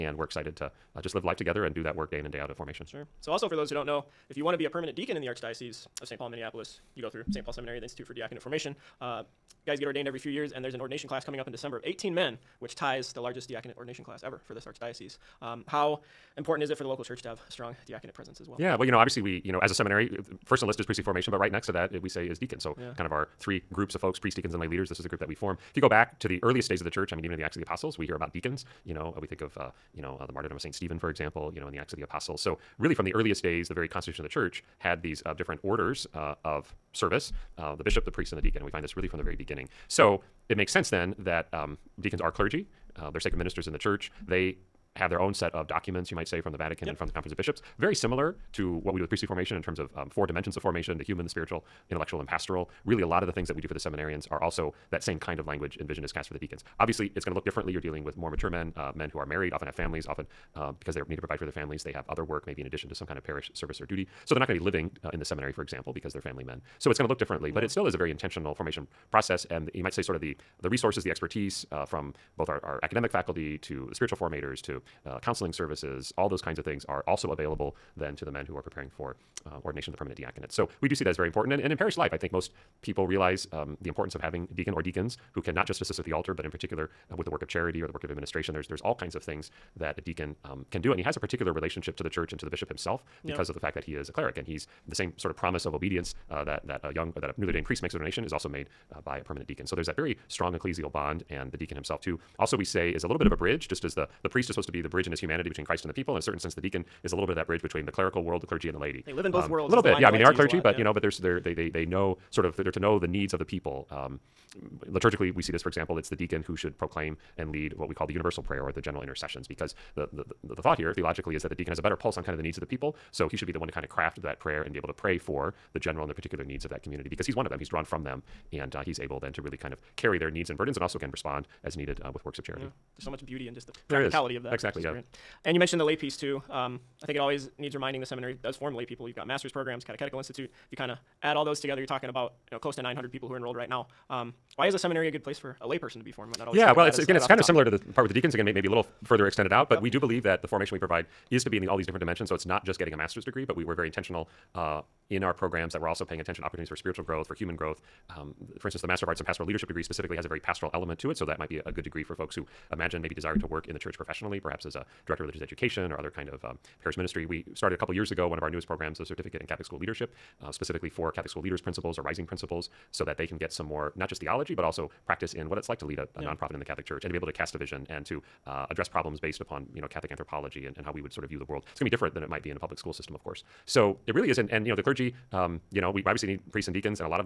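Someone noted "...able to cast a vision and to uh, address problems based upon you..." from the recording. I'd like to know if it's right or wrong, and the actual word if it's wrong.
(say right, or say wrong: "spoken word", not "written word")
right.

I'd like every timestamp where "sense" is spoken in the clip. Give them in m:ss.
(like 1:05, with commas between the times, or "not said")
0:40, 1:46.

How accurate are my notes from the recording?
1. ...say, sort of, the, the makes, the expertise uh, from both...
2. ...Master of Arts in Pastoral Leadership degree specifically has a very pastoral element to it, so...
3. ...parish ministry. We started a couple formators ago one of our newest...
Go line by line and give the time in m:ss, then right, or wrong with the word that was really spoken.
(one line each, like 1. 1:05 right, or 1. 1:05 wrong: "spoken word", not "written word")
1. 1:09 wrong: "resources", not "makes"
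2. 2:38 right
3. 2:46 wrong: "years", not "formators".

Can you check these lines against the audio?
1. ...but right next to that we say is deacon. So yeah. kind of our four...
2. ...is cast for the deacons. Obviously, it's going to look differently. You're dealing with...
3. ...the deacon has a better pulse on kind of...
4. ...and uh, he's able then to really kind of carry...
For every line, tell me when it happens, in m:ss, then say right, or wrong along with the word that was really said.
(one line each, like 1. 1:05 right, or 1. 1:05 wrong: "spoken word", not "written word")
1. 0:21 wrong: "three", not "four"
2. 0:56 right
3. 2:01 right
4. 2:08 right.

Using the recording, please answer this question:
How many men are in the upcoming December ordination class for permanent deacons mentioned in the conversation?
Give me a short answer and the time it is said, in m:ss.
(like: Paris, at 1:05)
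18, at 0:11.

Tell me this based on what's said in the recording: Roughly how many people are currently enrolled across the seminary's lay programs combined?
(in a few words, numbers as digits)
900.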